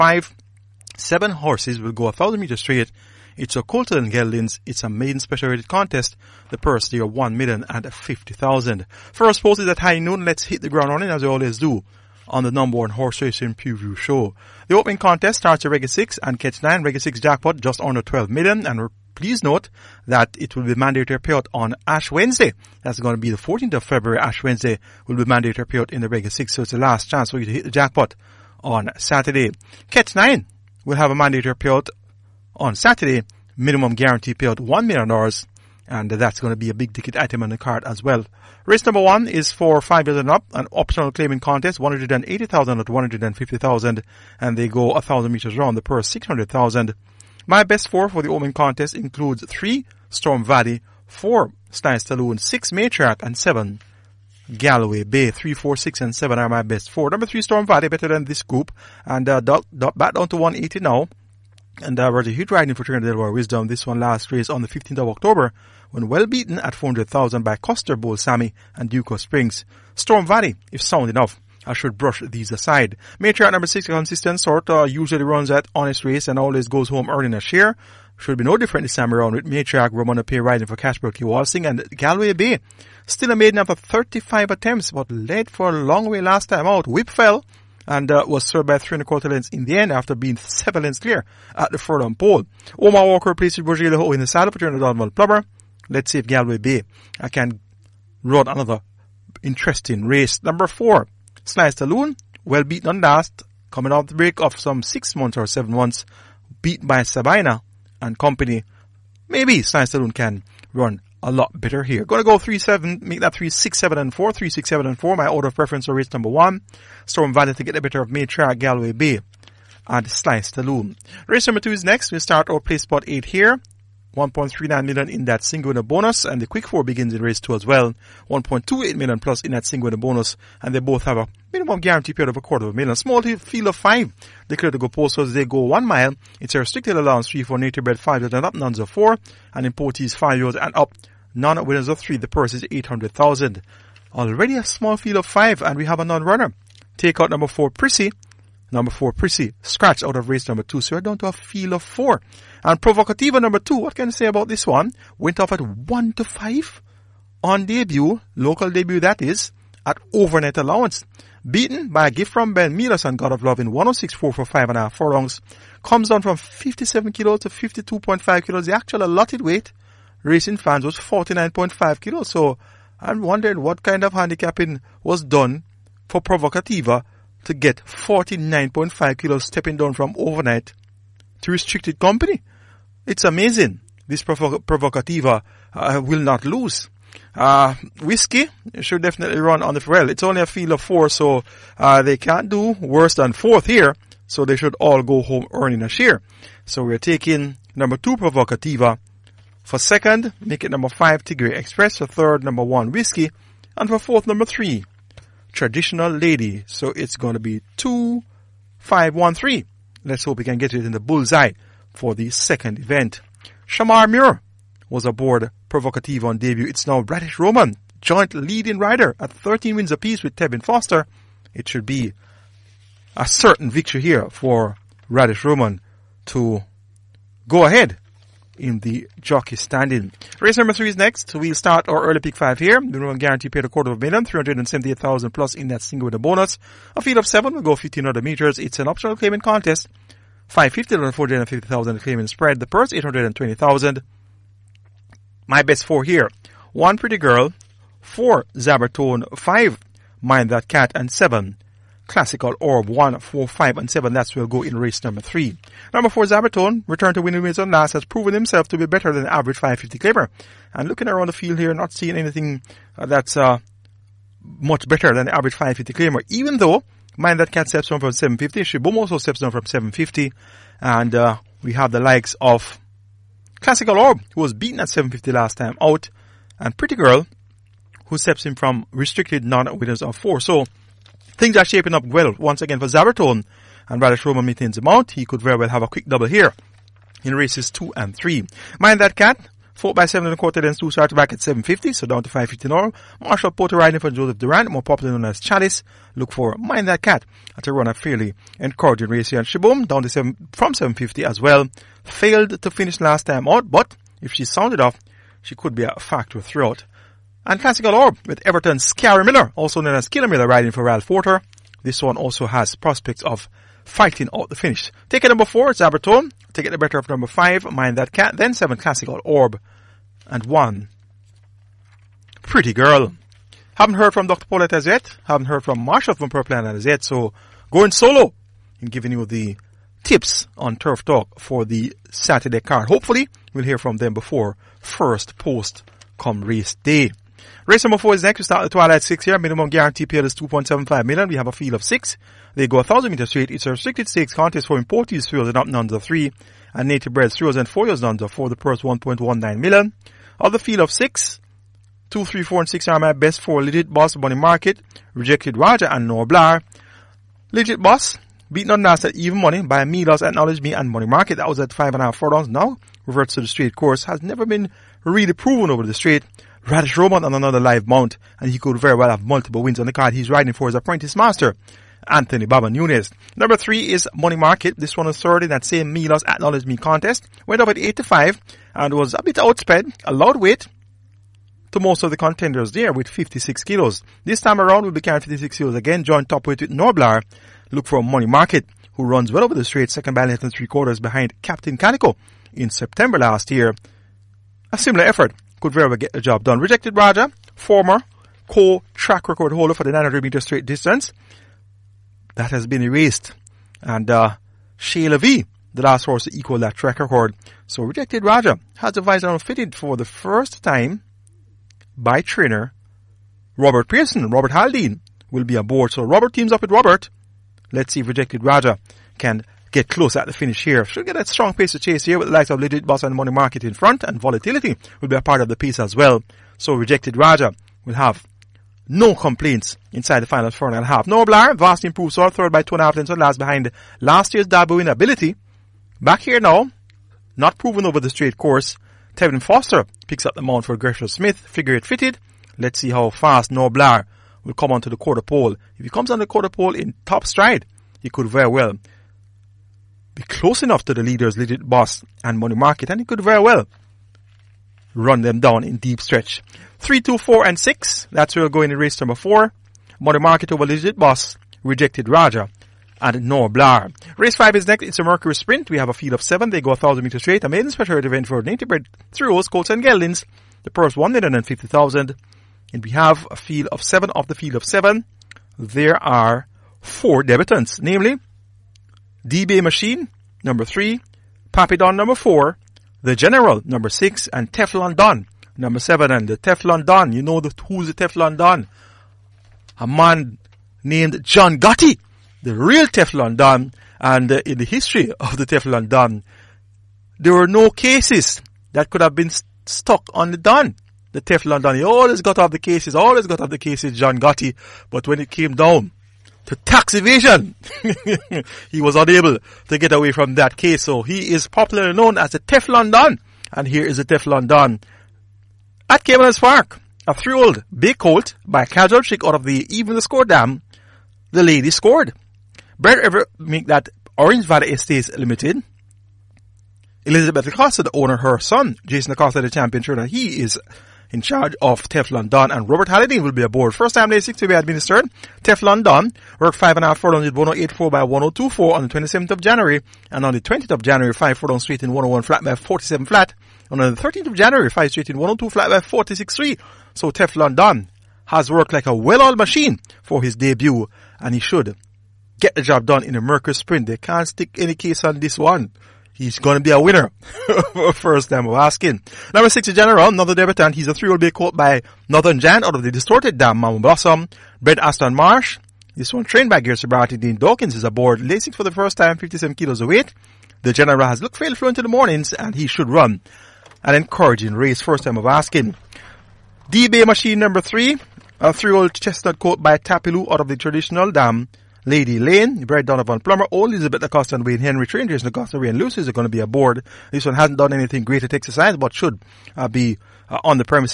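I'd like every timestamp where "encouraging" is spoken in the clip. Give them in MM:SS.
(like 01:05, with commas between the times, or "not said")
04:58, 09:33.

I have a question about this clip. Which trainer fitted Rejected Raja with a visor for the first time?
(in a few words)
Robert Pearson.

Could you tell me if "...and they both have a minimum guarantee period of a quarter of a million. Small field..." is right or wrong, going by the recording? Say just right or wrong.
right.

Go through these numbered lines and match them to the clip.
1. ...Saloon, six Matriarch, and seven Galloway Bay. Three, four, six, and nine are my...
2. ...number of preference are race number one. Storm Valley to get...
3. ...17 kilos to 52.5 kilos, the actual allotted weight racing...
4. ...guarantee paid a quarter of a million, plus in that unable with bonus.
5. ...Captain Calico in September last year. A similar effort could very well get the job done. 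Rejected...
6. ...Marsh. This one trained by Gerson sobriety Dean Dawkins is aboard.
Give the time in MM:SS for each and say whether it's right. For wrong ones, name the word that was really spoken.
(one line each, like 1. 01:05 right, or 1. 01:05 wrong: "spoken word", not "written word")
1. 00:51 wrong: "seven", not "nine"
2. 01:55 wrong: "order", not "number"
3. 02:46 wrong: "57", not "17"
4. 03:53 wrong: "single", not "unable"
5. 06:31 right
6. 09:25 right.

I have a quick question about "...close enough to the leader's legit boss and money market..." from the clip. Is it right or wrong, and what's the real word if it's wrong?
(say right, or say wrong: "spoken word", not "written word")
right.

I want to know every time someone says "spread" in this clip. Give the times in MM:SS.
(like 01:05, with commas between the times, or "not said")
04:02.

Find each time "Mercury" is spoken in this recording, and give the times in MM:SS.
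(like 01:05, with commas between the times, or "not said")
07:45, 09:13.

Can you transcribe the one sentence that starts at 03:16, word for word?
So we're taking number two Provocativa for second, make it number five Tigray Express.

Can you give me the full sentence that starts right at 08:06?
And the Teflon Don, you know the, who's the Teflon Don?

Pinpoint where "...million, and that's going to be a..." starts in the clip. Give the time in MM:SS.
00:34.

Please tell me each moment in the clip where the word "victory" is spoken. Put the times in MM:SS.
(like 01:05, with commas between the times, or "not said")
03:43.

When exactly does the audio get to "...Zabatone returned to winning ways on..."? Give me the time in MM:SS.
04:16.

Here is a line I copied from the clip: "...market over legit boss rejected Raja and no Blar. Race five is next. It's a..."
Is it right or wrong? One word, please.
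right.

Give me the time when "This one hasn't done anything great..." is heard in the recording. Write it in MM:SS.
09:47.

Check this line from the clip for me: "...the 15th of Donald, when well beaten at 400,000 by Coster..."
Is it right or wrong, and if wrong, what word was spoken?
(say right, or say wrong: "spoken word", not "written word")
wrong: "October", not "Donald".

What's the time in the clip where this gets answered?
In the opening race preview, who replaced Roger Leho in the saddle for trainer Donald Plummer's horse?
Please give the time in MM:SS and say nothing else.
01:32.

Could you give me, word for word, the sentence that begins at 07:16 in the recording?
Back here now, not proven over the straight course.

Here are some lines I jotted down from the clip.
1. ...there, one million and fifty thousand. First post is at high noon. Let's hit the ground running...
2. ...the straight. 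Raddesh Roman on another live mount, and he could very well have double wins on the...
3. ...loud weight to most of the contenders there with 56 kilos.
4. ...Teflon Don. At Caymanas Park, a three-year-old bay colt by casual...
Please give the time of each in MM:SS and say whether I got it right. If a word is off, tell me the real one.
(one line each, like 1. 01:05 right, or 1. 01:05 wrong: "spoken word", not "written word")
1. 00:06 right
2. 06:05 wrong: "multiple", not "double"
3. 06:20 right
4. 08:34 right.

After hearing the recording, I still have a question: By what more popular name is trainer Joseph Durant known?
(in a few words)
Chalice.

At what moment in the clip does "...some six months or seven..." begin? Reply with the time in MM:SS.
01:44.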